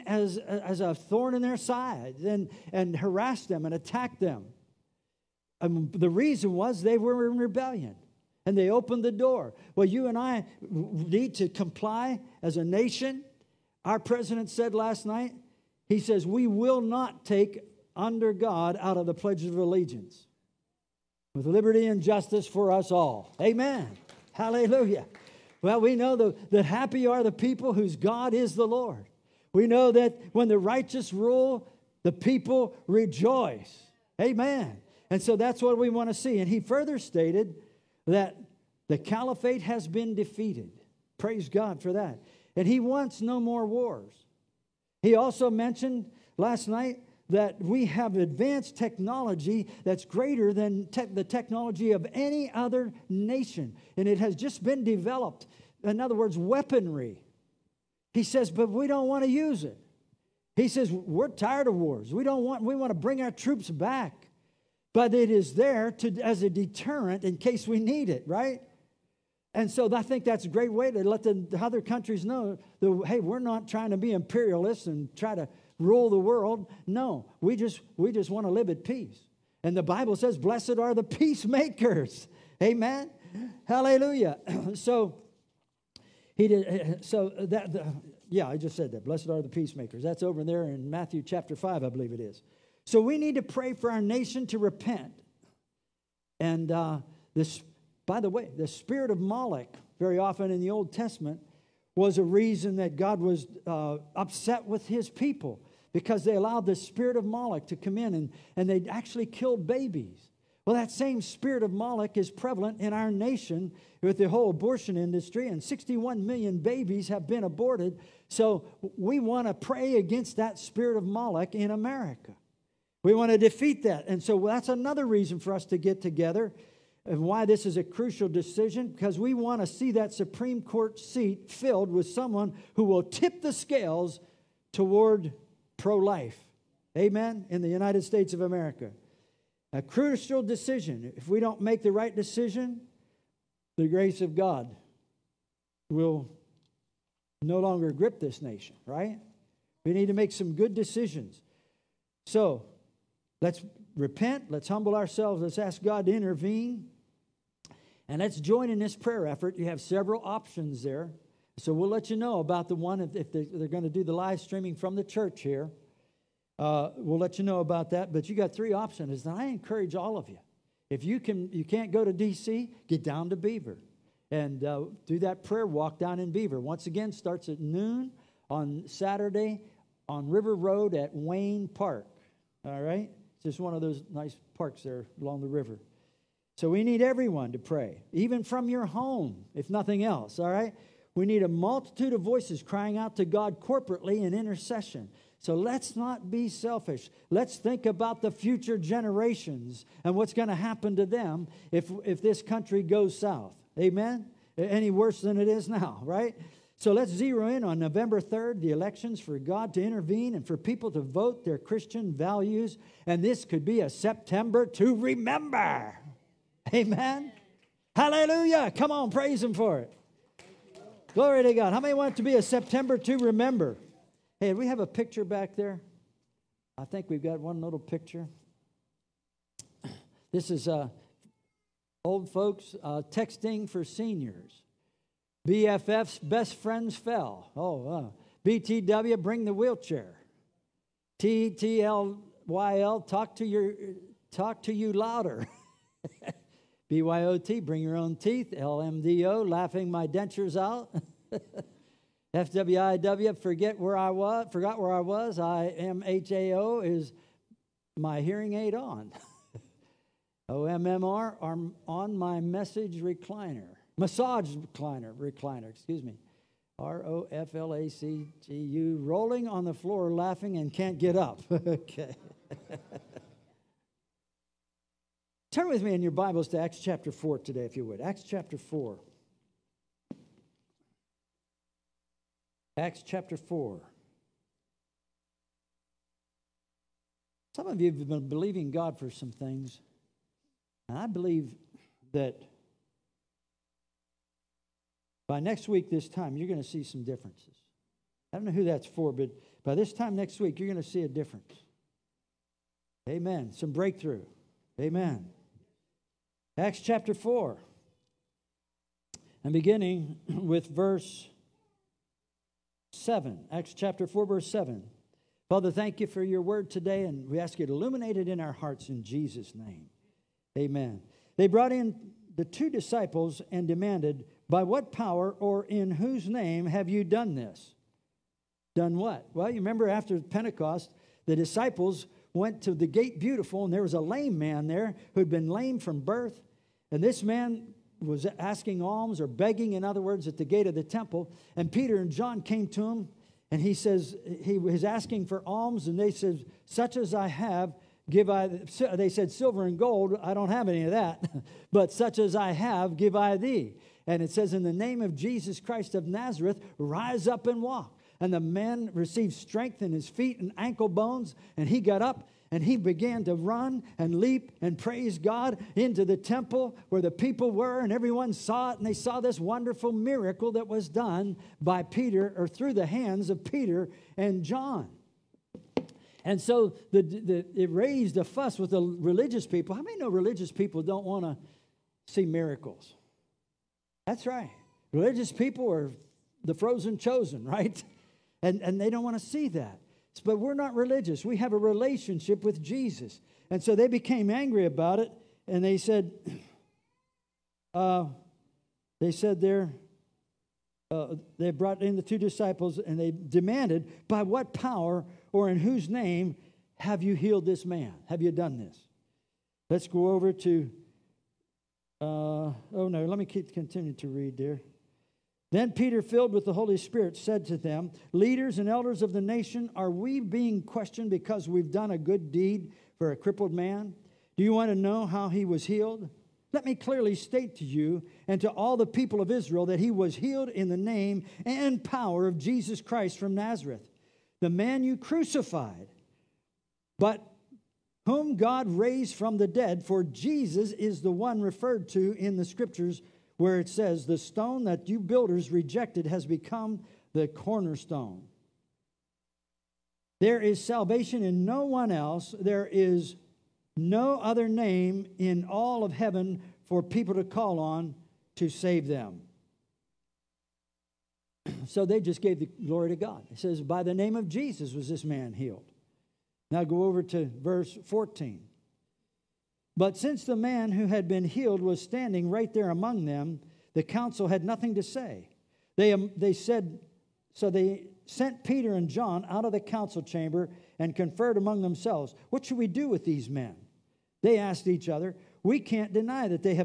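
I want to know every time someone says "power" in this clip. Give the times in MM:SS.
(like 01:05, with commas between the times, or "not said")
05:24, 06:44, 07:11.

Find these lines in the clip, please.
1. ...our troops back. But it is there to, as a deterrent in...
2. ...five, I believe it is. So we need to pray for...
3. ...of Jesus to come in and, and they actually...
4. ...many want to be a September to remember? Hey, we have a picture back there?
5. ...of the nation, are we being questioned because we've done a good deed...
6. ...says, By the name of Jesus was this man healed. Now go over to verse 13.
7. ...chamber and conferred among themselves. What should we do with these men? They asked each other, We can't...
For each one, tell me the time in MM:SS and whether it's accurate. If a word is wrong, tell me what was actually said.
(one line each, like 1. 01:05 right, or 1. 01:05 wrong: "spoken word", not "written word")
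1. 01:03 right
2. 01:31 right
3. 01:47 wrong: "Moloch", not "Jesus"
4. 03:41 right
5. 06:59 right
6. 07:43 wrong: "14", not "13"
7. 08:00 right.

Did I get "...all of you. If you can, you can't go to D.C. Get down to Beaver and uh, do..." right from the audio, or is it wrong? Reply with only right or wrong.
right.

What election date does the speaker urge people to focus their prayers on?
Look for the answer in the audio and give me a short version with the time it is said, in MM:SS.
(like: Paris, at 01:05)
November 3rd, at 03:27.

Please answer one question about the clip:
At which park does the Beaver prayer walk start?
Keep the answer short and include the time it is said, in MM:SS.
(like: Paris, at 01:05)
Wayne Park, at 03:01.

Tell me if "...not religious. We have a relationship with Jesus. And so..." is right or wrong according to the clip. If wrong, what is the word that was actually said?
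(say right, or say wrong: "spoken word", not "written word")
right.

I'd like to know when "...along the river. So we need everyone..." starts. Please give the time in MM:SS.
03:05.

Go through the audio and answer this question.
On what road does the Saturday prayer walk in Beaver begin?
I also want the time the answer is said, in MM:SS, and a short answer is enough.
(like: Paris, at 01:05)
River Road, at 03:00.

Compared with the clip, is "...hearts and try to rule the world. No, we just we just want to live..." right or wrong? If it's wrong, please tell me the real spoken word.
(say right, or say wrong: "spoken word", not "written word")
wrong: "imperialists", not "hearts".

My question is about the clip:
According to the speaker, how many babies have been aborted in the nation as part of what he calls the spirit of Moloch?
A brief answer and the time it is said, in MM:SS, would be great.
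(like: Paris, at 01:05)
61 million, at 01:55.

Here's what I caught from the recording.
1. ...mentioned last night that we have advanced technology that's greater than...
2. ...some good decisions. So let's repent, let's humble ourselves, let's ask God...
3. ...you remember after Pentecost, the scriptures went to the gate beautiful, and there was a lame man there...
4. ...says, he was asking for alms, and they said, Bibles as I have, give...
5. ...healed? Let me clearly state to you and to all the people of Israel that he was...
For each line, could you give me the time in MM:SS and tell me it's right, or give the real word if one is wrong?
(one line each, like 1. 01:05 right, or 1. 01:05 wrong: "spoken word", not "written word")
1. 00:45 right
2. 02:30 right
3. 05:29 wrong: "disciples", not "scriptures"
4. 05:43 wrong: "Such", not "Bibles"
5. 07:05 right.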